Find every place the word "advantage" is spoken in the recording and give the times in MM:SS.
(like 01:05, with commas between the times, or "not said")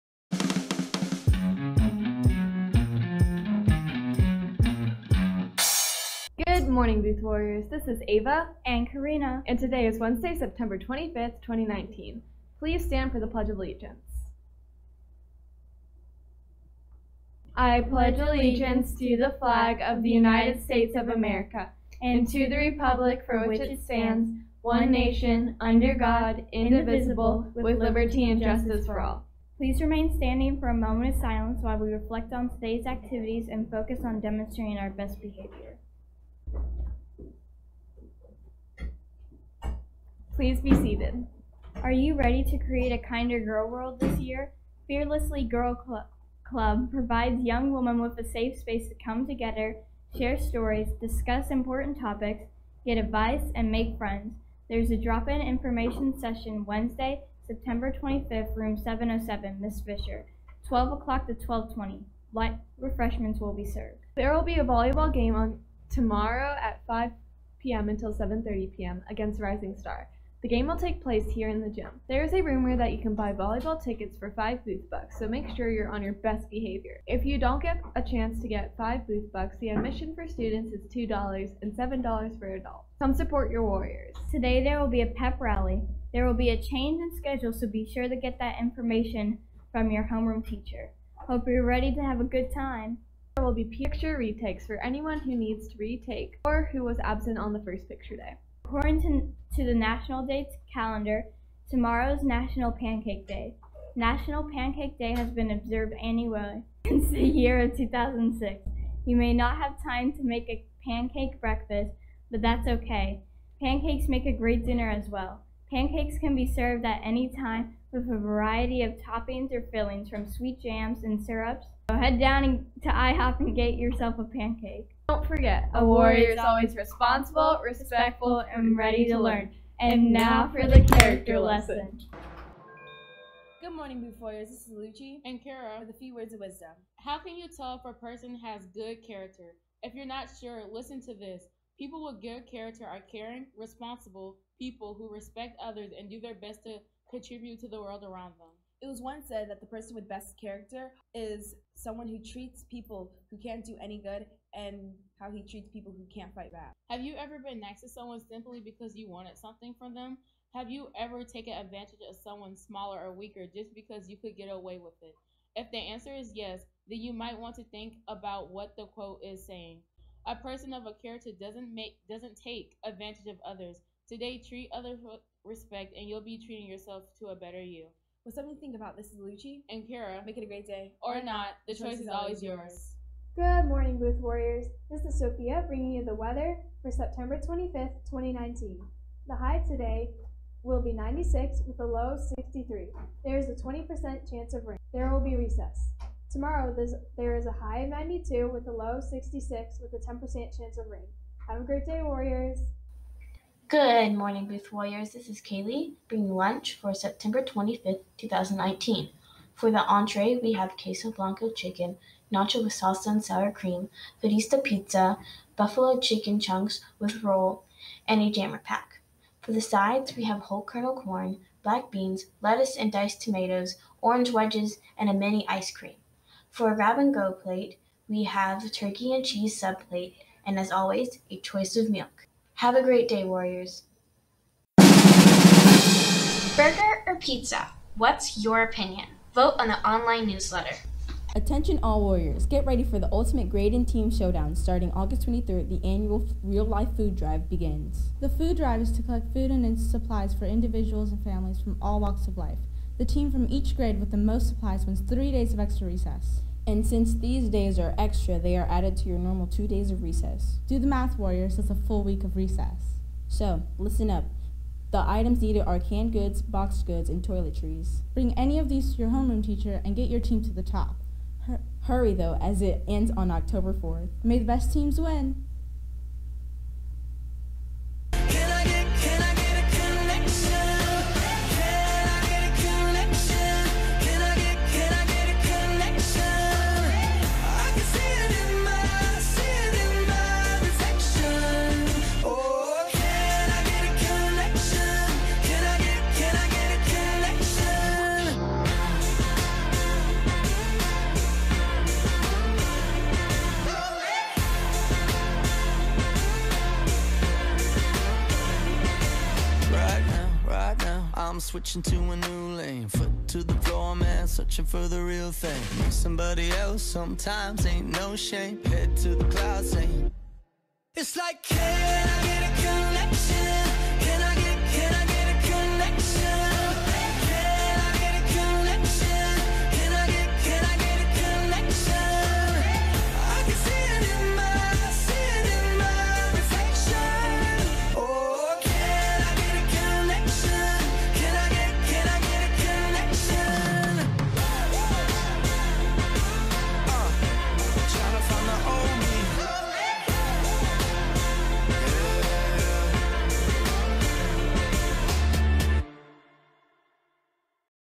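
02:41, 02:52.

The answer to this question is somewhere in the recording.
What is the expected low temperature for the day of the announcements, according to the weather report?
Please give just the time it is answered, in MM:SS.
03:12.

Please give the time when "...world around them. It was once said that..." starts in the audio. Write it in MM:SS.
02:27.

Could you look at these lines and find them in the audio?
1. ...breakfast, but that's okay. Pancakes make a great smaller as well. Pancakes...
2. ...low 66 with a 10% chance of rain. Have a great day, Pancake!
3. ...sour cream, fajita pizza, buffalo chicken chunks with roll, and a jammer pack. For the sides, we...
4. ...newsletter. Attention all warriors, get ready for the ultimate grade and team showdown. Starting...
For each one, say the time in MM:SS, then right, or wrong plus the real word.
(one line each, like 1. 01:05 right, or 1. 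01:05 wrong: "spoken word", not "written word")
1. 01:51 wrong: "dinner", not "smaller"
2. 03:18 wrong: "Warriors", not "Pancake"
3. 03:33 right
4. 04:00 right.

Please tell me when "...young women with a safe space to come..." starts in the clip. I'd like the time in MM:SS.
00:47.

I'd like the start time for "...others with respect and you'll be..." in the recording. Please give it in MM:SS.
02:54.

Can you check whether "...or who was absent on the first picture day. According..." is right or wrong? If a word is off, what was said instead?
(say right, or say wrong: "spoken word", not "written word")
right.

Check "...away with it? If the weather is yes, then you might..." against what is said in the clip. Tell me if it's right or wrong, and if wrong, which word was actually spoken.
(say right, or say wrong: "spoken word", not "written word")
wrong: "answer", not "weather".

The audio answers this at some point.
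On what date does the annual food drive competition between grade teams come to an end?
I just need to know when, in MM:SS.
04:33.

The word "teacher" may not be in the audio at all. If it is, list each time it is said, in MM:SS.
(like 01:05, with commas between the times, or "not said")
01:30, 04:29.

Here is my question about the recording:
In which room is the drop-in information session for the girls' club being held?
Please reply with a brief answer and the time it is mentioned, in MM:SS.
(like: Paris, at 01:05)
707, at 00:58.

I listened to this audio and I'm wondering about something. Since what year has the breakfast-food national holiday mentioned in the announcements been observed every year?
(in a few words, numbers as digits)
2006.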